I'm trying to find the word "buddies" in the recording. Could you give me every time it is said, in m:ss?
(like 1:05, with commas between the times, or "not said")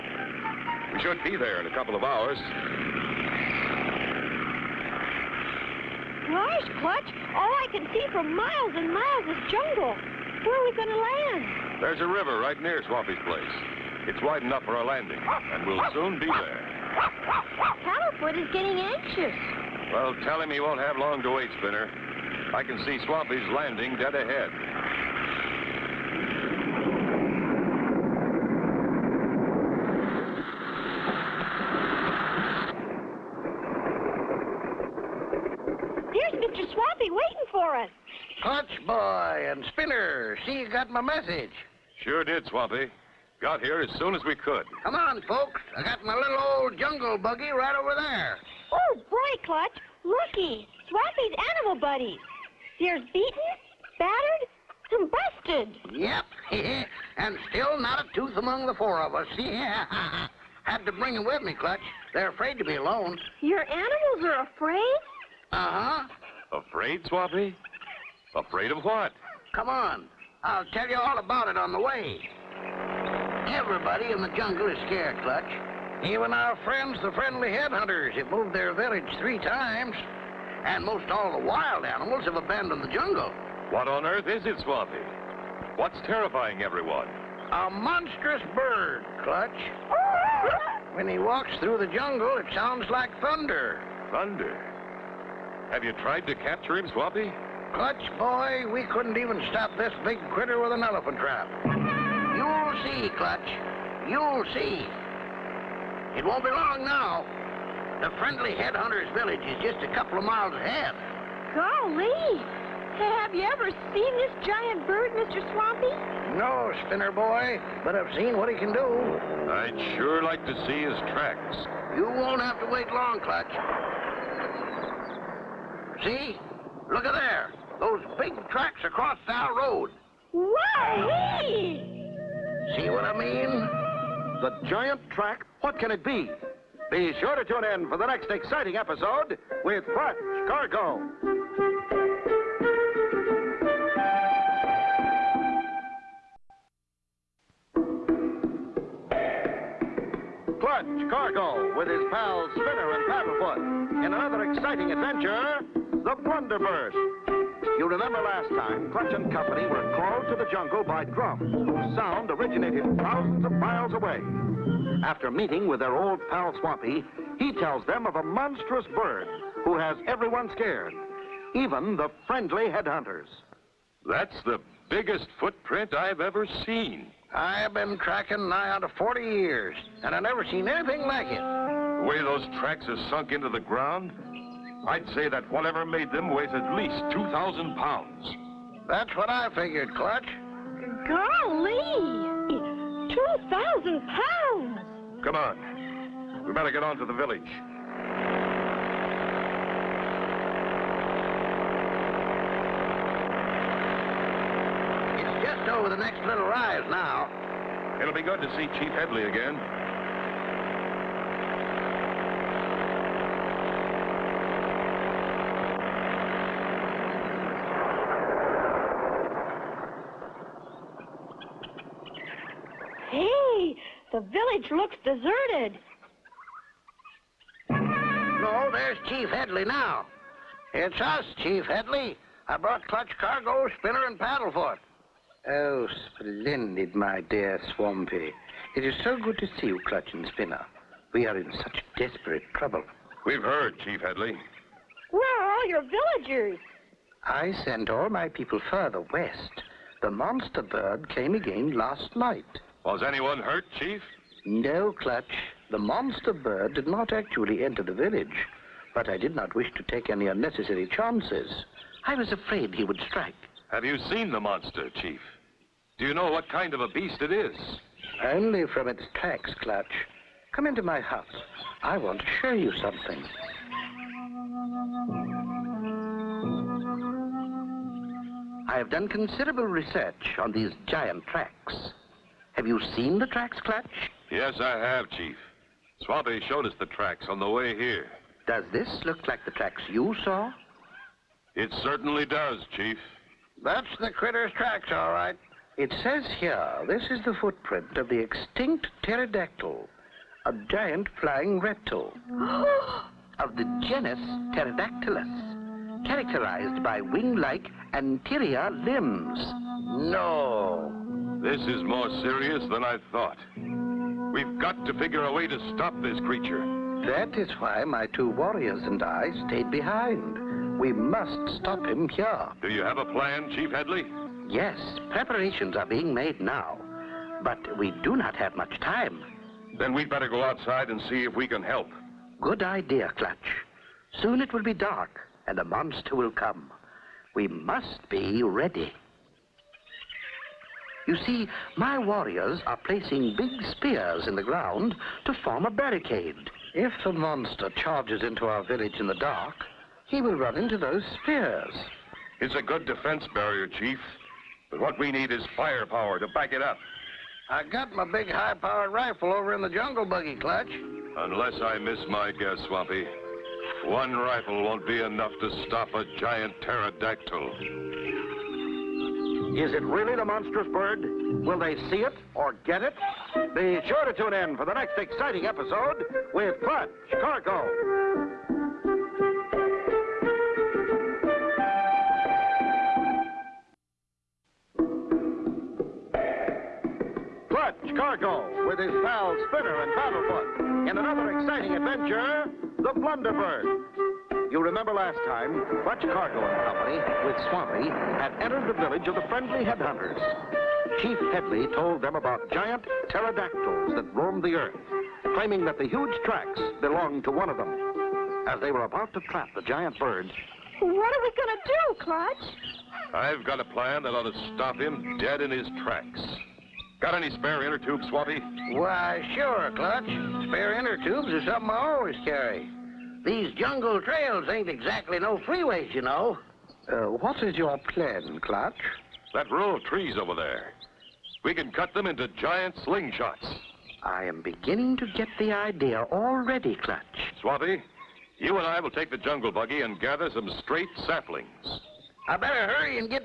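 0:51.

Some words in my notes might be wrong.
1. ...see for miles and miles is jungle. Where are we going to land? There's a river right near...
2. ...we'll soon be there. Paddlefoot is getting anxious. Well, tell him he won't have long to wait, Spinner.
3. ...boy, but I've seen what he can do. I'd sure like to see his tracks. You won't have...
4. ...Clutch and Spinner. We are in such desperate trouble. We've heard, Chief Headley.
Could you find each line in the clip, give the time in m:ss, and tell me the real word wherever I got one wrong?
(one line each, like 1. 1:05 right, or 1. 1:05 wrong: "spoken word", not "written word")
1. 0:07 right
2. 0:15 right
3. 1:57 right
4. 3:59 right.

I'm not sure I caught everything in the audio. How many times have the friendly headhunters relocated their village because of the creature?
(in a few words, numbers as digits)
3.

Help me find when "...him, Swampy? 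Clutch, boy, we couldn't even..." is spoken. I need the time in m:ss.
1:36.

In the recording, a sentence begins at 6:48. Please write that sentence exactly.
As they were about to trap the giant birds...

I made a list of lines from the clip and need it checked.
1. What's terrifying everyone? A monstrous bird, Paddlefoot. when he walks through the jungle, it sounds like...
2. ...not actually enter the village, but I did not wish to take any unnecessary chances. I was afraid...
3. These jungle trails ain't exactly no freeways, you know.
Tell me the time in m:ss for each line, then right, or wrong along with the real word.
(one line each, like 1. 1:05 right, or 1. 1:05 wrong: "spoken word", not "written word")
1. 1:25 wrong: "Clutch", not "Paddlefoot"
2. 4:16 right
3. 7:03 right.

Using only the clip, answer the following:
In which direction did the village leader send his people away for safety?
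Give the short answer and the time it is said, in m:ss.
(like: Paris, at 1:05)
West, at 4:09.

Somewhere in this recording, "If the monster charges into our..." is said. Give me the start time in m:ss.
5:46.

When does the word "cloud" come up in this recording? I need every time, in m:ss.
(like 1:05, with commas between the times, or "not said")
not said.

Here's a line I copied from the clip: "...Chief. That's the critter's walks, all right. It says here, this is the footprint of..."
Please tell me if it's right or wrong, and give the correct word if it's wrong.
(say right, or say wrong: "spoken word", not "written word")
wrong: "tracks", not "walks".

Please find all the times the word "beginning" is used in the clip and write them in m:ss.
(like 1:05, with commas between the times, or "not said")
7:14.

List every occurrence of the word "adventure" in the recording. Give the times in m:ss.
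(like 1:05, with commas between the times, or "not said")
2:34, 6:31.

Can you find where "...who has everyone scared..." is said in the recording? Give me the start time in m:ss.
2:49.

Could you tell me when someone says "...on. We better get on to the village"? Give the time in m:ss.
3:15.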